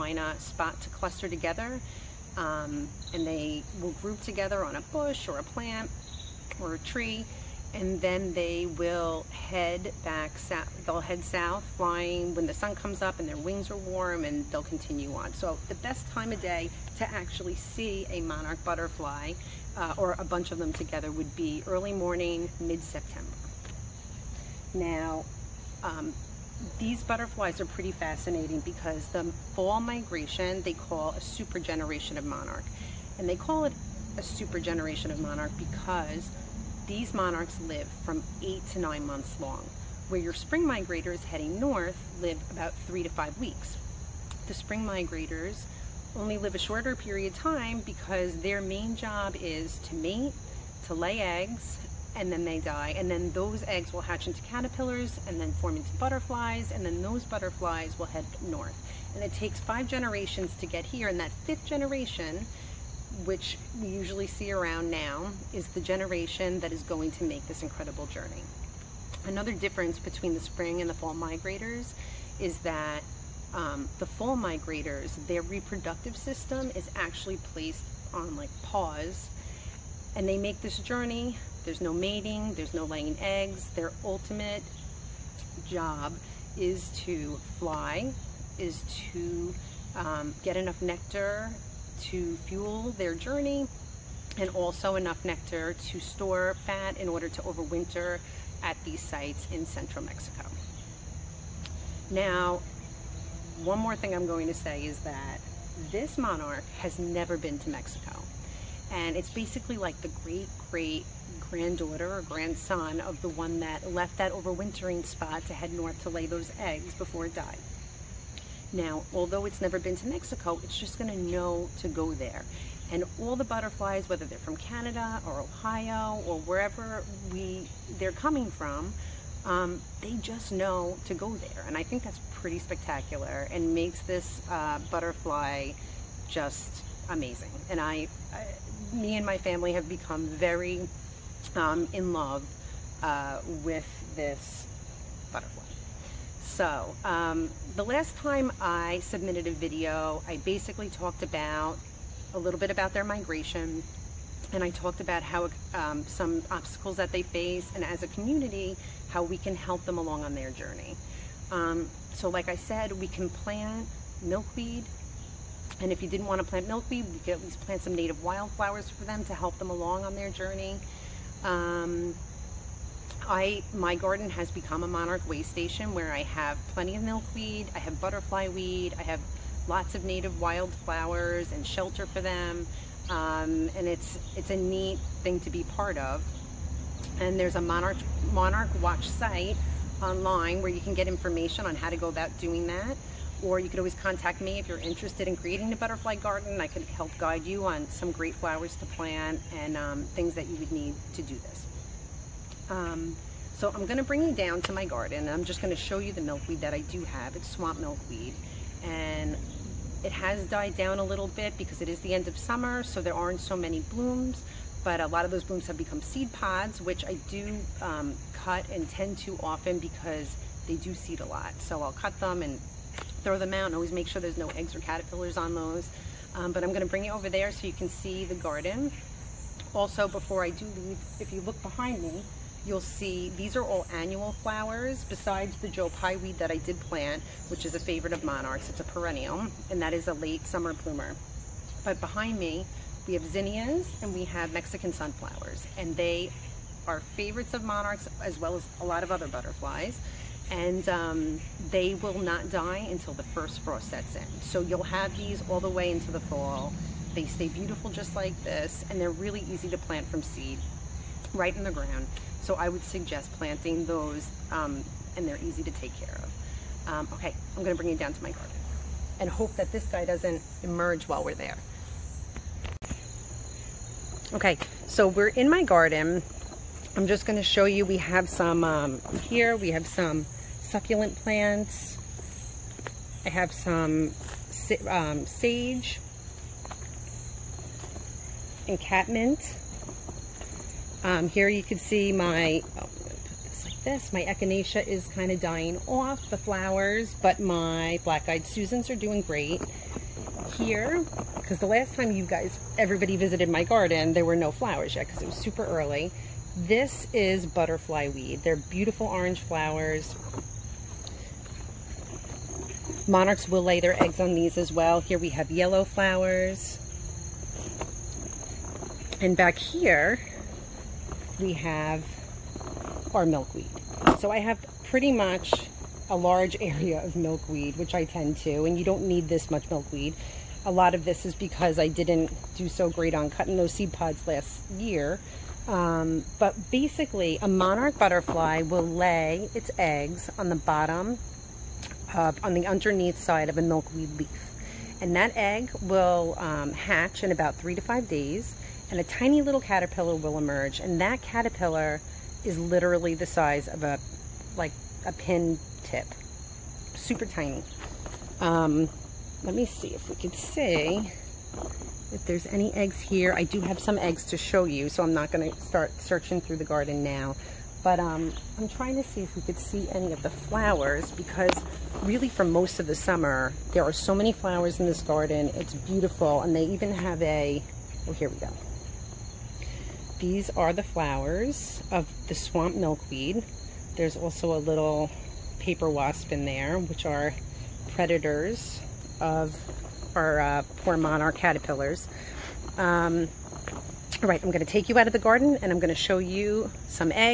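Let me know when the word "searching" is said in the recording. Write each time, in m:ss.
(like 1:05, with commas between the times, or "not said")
6:05.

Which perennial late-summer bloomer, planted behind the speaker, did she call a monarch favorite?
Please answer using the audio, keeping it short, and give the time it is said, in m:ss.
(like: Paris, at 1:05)
Joe Pye weed, at 3:55.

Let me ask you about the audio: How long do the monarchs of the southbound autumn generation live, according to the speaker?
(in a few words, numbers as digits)
8 to 9 months.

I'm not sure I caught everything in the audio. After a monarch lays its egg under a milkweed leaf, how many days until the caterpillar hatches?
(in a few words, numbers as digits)
3 to 5 days.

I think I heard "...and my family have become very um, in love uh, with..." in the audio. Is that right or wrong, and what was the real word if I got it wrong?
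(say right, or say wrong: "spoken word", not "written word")
right.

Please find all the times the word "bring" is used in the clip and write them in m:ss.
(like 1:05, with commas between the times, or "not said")
3:24, 3:46, 4:27.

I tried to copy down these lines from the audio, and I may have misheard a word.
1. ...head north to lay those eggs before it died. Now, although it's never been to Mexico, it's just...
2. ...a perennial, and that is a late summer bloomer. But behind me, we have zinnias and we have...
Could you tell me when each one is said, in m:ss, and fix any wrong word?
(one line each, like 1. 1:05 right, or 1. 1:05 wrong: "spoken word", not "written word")
1. 1:55 right
2. 3:58 right.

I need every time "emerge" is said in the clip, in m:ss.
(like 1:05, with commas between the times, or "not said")
4:30, 5:50.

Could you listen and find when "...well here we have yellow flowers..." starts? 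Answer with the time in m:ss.
5:14.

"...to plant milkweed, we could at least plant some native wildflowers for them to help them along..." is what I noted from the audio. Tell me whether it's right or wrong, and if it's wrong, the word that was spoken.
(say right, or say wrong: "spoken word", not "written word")
right.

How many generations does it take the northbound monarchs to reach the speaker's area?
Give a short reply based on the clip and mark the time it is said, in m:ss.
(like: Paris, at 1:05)
5, at 0:59.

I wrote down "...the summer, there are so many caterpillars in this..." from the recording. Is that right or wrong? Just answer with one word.
wrong.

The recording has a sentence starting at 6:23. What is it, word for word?
There's also a little paper wasp in there, which are predators of our uh, poor monarch caterpillars.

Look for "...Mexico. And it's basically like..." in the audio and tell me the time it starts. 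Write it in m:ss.
1:47.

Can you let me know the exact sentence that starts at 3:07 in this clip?
And there's a monarch monarch watch site online where you can get information on how to go about doing that.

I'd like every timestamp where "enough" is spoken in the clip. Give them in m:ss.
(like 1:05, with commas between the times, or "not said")
1:30, 1:34.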